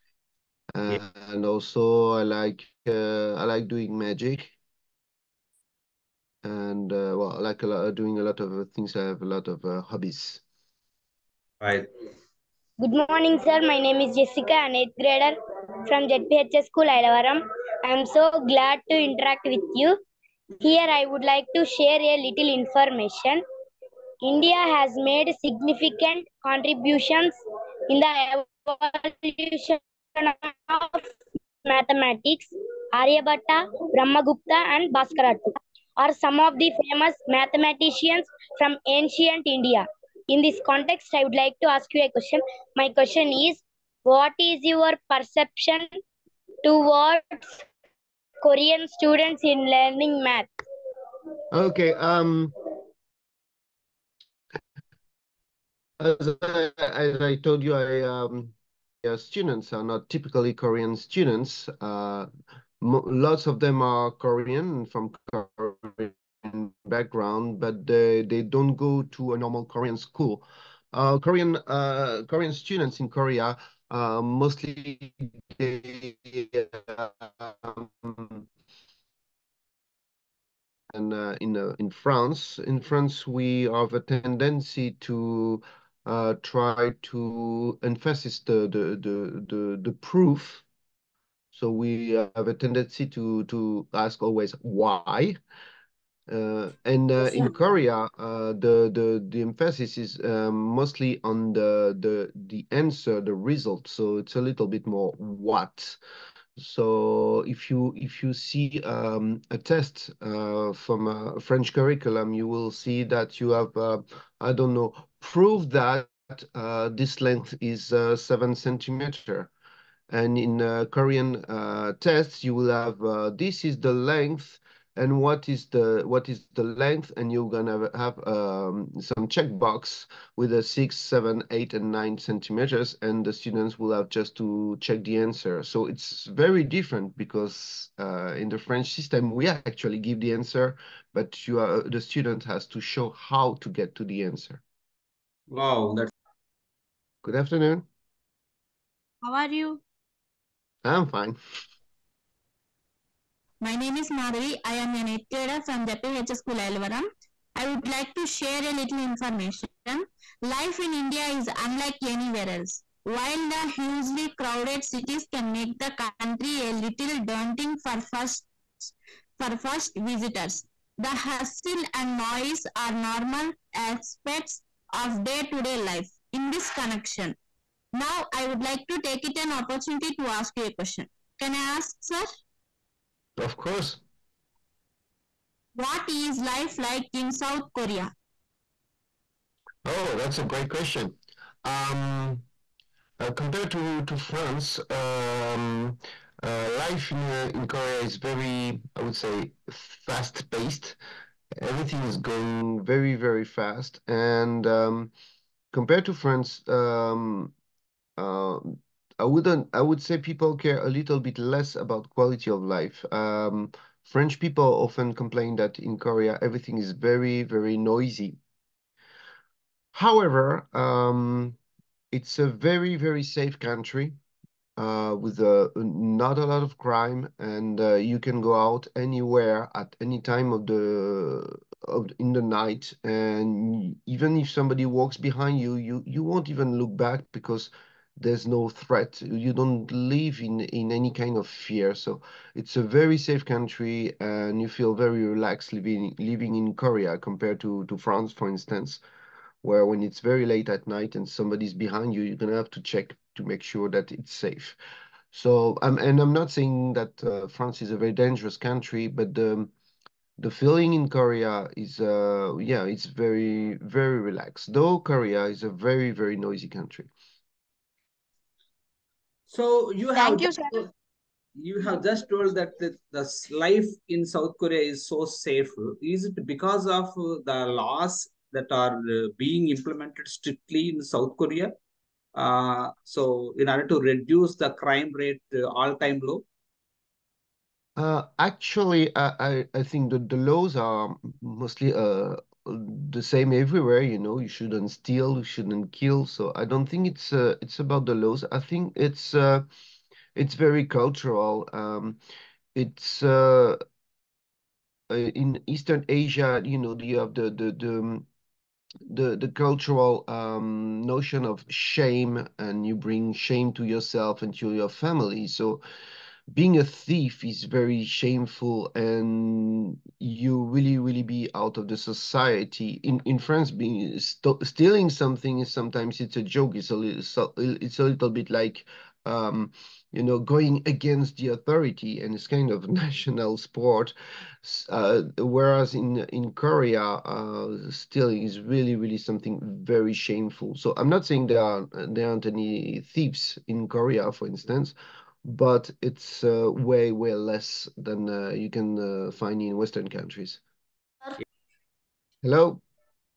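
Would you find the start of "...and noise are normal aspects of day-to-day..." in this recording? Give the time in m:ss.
2:51.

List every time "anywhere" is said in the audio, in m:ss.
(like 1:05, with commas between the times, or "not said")
2:42, 3:48.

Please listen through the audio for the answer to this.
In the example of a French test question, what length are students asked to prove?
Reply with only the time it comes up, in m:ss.
1:58.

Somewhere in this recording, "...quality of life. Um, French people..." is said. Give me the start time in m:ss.
3:32.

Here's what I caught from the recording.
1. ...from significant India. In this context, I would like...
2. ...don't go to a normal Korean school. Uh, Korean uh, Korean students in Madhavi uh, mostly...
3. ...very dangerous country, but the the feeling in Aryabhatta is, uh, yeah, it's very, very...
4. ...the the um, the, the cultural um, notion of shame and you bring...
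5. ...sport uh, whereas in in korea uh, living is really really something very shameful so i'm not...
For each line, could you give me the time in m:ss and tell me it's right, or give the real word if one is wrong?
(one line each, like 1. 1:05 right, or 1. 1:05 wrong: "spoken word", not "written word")
1. 0:38 wrong: "ancient", not "significant"
2. 1:08 wrong: "Korea", not "Madhavi"
3. 4:17 wrong: "Korea", not "Aryabhatta"
4. 5:07 right
5. 5:33 wrong: "stealing", not "living".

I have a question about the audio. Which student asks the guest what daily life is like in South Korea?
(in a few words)
Madhavi.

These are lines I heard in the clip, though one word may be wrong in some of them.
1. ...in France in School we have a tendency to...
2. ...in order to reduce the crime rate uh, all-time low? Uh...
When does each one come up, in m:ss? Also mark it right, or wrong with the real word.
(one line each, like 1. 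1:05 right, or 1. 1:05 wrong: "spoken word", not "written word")
1. 1:21 wrong: "France", not "School"
2. 4:43 right.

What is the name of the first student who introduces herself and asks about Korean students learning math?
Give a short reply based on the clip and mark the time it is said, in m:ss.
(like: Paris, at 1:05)
Jessica, at 0:14.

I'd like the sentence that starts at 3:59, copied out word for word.
You don't live in, in any kind of fear.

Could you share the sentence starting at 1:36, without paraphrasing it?
Uh, and uh, in Korea, uh, the the the emphasis is um, mostly on the the the answer, the result.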